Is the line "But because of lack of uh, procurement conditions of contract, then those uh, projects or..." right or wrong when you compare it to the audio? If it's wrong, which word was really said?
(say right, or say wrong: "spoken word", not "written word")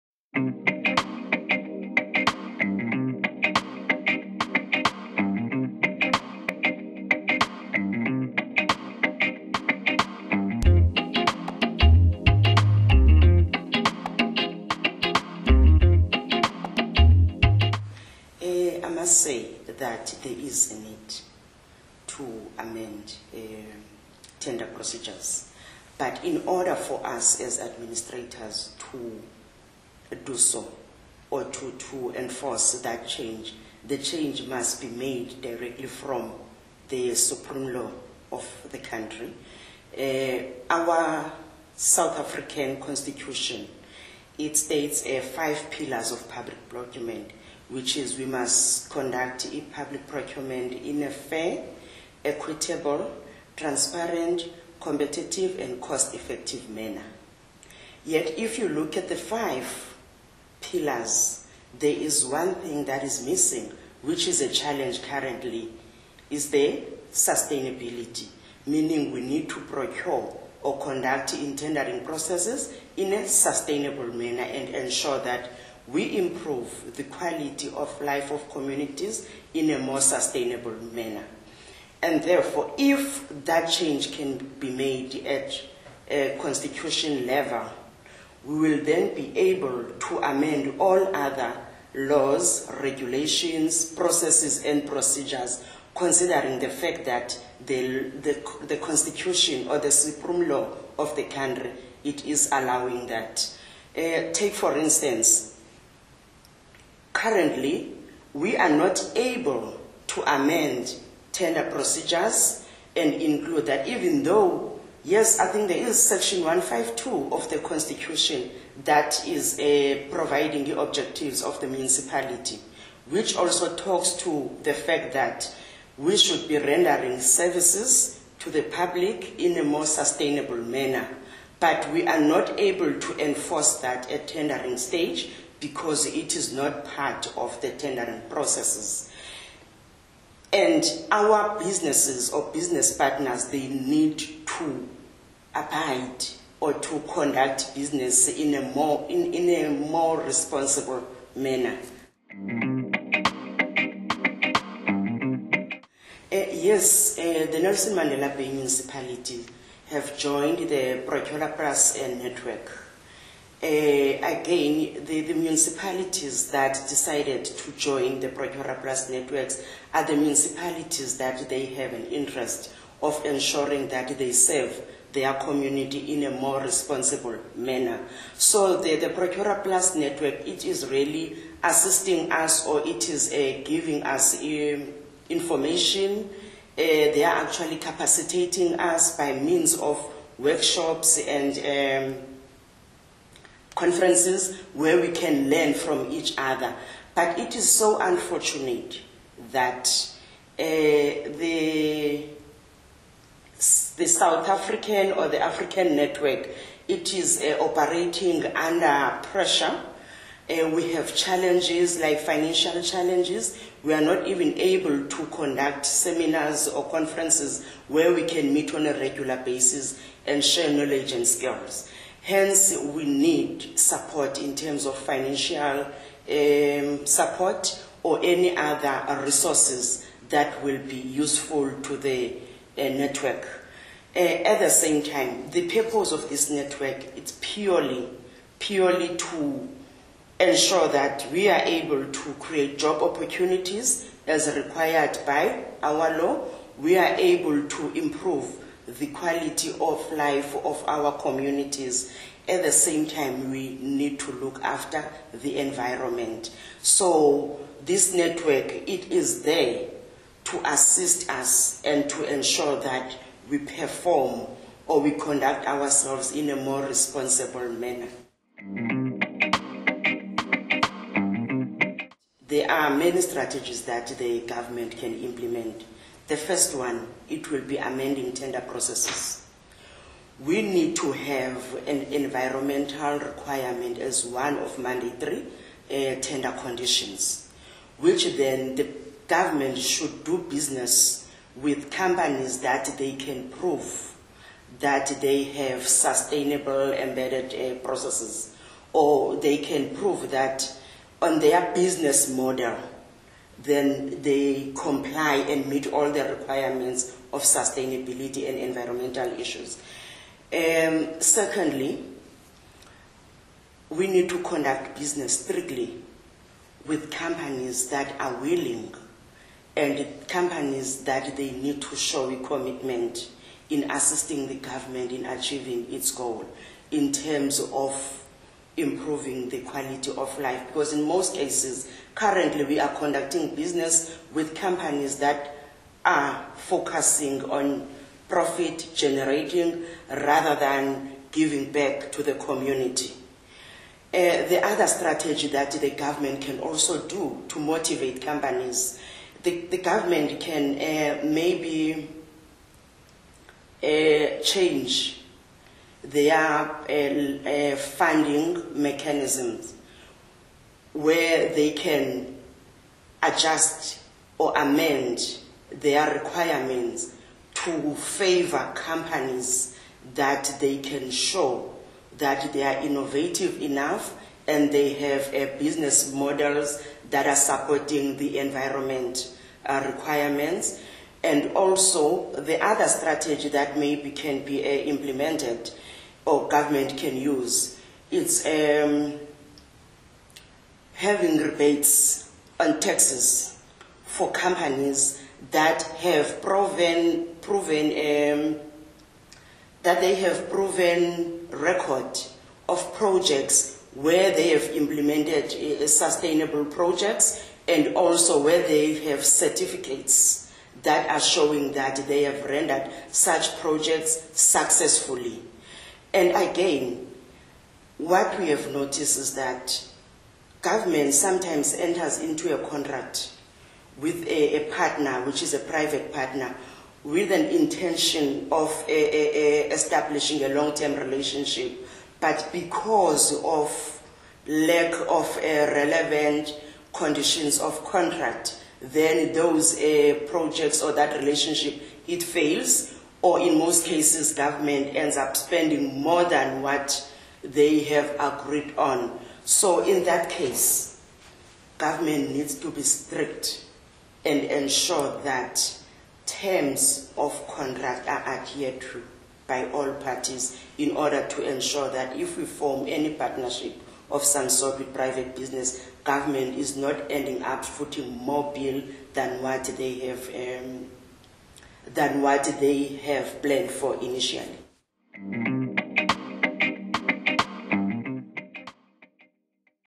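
wrong: "relevant", not "procurement".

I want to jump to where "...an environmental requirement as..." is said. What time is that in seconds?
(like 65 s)
281 s.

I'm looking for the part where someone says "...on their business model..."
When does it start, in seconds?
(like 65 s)
301 s.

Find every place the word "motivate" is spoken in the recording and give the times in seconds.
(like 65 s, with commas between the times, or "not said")
347 s.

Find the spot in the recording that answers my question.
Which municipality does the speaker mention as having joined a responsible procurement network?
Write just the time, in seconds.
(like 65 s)
157 s.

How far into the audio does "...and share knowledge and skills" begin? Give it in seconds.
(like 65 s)
220 s.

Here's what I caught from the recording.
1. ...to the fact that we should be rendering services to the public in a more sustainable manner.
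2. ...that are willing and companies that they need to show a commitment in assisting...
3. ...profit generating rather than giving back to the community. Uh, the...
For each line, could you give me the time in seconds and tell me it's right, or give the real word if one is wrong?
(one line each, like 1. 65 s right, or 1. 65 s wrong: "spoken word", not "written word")
1. 124 s right
2. 317 s right
3. 338 s right.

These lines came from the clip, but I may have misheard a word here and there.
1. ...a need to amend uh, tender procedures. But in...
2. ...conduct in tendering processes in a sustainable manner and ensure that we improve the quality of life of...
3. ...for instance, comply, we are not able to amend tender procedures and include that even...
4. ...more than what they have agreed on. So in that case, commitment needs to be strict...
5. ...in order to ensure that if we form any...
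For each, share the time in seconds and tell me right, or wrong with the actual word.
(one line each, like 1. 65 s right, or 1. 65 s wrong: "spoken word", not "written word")
1. 20 s right
2. 70 s right
3. 104 s wrong: "currently", not "comply"
4. 446 s wrong: "government", not "commitment"
5. 460 s right.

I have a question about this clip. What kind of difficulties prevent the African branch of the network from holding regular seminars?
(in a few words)
Financial challenges.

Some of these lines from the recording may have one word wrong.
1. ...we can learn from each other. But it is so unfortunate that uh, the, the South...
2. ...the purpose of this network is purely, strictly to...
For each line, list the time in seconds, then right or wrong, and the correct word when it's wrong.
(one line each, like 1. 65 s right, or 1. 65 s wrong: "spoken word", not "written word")
1. 194 s right
2. 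235 s wrong: "purely", not "strictly".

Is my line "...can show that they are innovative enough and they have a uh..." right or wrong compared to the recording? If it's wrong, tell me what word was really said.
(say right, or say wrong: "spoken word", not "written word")
right.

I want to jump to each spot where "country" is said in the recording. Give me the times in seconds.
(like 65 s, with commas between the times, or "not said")
38 s, 101 s.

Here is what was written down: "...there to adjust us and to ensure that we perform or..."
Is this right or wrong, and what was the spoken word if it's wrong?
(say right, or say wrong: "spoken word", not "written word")
wrong: "assist", not "adjust".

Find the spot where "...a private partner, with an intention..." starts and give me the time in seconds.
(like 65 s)
425 s.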